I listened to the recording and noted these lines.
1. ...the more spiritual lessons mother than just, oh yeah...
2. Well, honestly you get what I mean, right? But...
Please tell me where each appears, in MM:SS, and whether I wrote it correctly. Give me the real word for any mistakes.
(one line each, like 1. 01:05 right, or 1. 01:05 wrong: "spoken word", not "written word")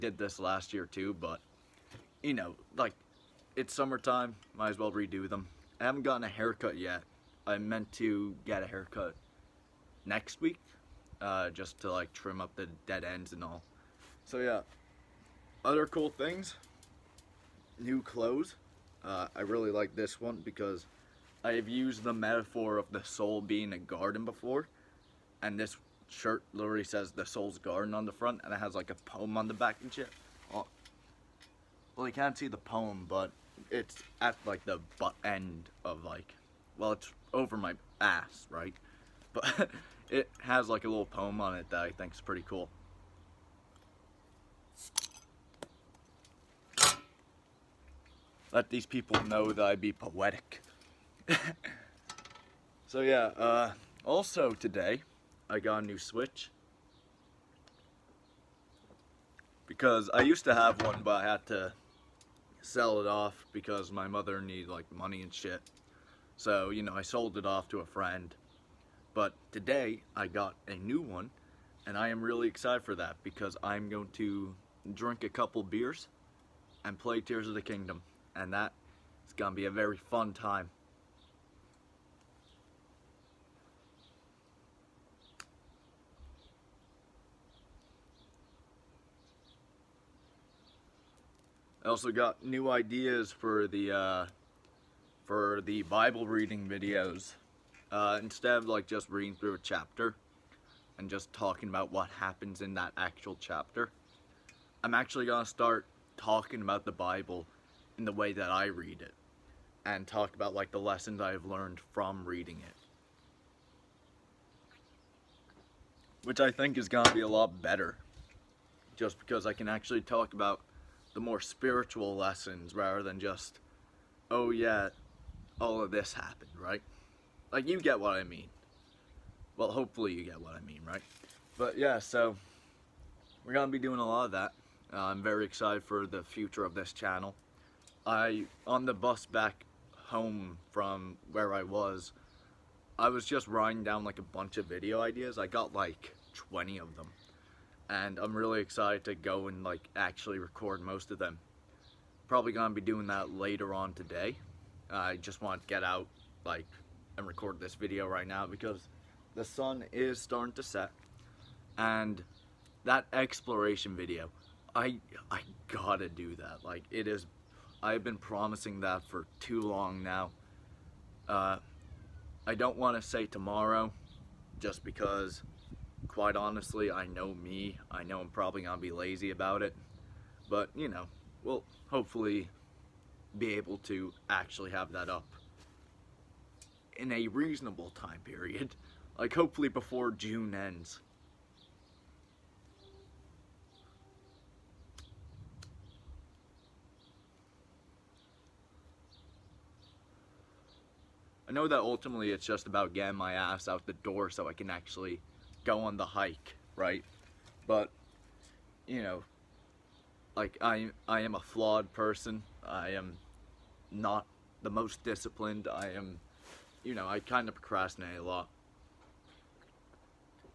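1. 02:01 wrong: "rather", not "mother"
2. 02:09 wrong: "hopefully", not "honestly".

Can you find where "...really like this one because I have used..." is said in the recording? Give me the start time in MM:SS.
00:19.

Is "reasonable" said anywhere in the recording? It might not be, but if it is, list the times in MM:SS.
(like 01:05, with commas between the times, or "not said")
03:07.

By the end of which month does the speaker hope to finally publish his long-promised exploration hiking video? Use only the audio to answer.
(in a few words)
June.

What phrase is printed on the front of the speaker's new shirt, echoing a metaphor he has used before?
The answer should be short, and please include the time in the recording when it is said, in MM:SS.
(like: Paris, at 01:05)
The soul's garden, at 00:27.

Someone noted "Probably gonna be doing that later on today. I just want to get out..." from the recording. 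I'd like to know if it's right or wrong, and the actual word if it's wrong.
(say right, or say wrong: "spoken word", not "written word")
right.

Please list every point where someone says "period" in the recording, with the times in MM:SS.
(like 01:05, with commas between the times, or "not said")
03:08.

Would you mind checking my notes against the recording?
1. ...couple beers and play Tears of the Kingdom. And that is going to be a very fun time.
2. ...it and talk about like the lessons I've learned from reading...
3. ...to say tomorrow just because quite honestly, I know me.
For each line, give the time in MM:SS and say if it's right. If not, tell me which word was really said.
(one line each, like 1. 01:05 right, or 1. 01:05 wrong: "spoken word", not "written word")
1. 01:15 right
2. 01:49 right
3. 02:52 right.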